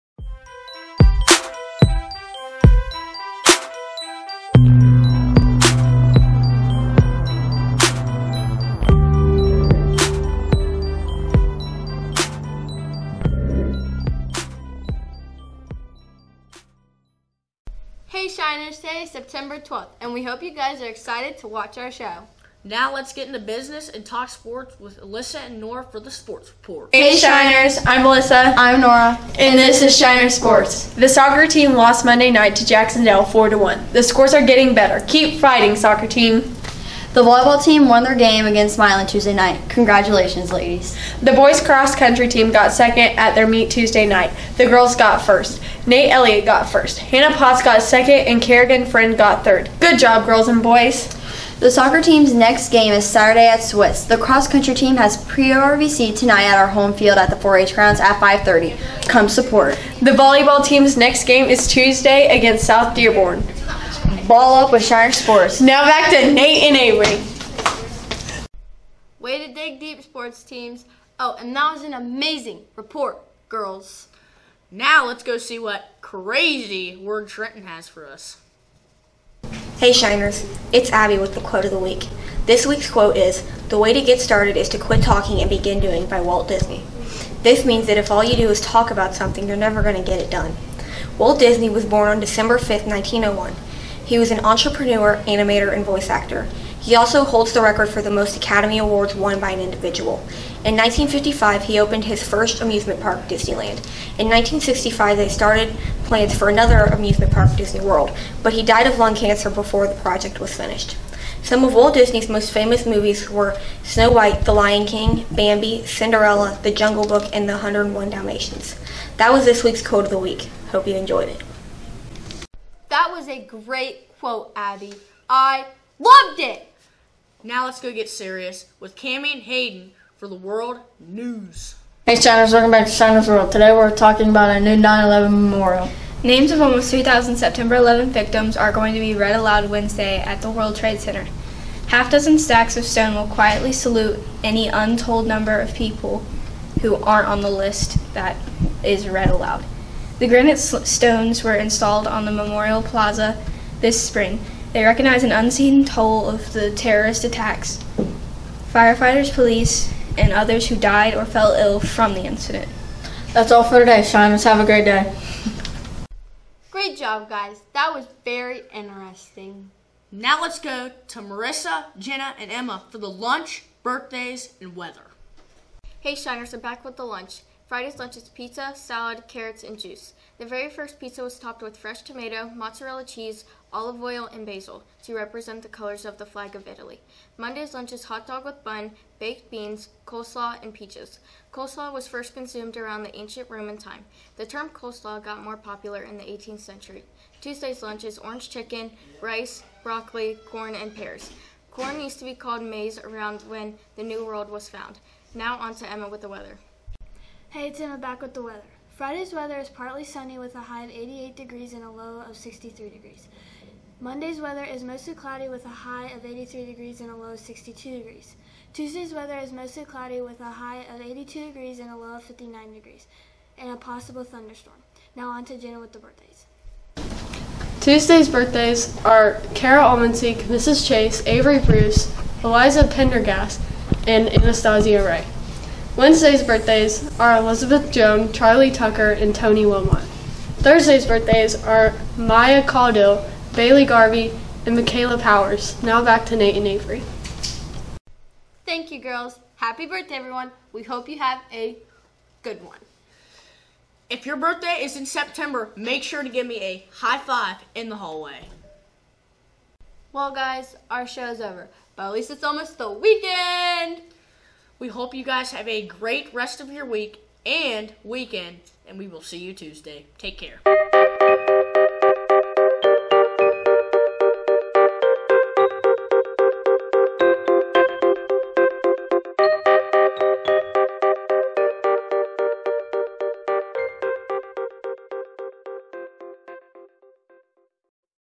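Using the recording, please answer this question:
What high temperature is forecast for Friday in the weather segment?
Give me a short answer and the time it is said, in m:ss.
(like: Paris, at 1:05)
88 degrees, at 3:30.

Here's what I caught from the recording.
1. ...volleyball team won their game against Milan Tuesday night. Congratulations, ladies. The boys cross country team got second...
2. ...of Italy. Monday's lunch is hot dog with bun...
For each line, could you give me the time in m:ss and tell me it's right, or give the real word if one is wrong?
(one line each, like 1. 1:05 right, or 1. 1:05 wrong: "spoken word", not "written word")
1. 0:37 right
2. 3:06 right.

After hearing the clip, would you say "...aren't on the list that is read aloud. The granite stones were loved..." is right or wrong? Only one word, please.
wrong.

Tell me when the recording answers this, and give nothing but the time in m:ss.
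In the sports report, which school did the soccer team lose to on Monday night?
0:32.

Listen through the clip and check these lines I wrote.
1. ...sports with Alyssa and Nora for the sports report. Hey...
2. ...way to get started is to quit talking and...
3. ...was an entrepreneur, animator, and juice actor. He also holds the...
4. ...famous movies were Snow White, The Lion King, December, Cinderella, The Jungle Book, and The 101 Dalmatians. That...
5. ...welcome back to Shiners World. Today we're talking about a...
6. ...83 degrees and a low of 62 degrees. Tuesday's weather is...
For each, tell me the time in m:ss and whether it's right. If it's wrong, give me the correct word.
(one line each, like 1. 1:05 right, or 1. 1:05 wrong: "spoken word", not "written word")
1. 0:24 right
2. 1:23 right
3. 1:34 wrong: "voice", not "juice"
4. 1:52 wrong: "Bambi", not "December"
5. 2:12 right
6. 3:36 right.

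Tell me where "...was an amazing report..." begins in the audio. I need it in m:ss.
1:11.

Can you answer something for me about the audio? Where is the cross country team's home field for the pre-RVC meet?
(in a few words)
the 4-H grounds.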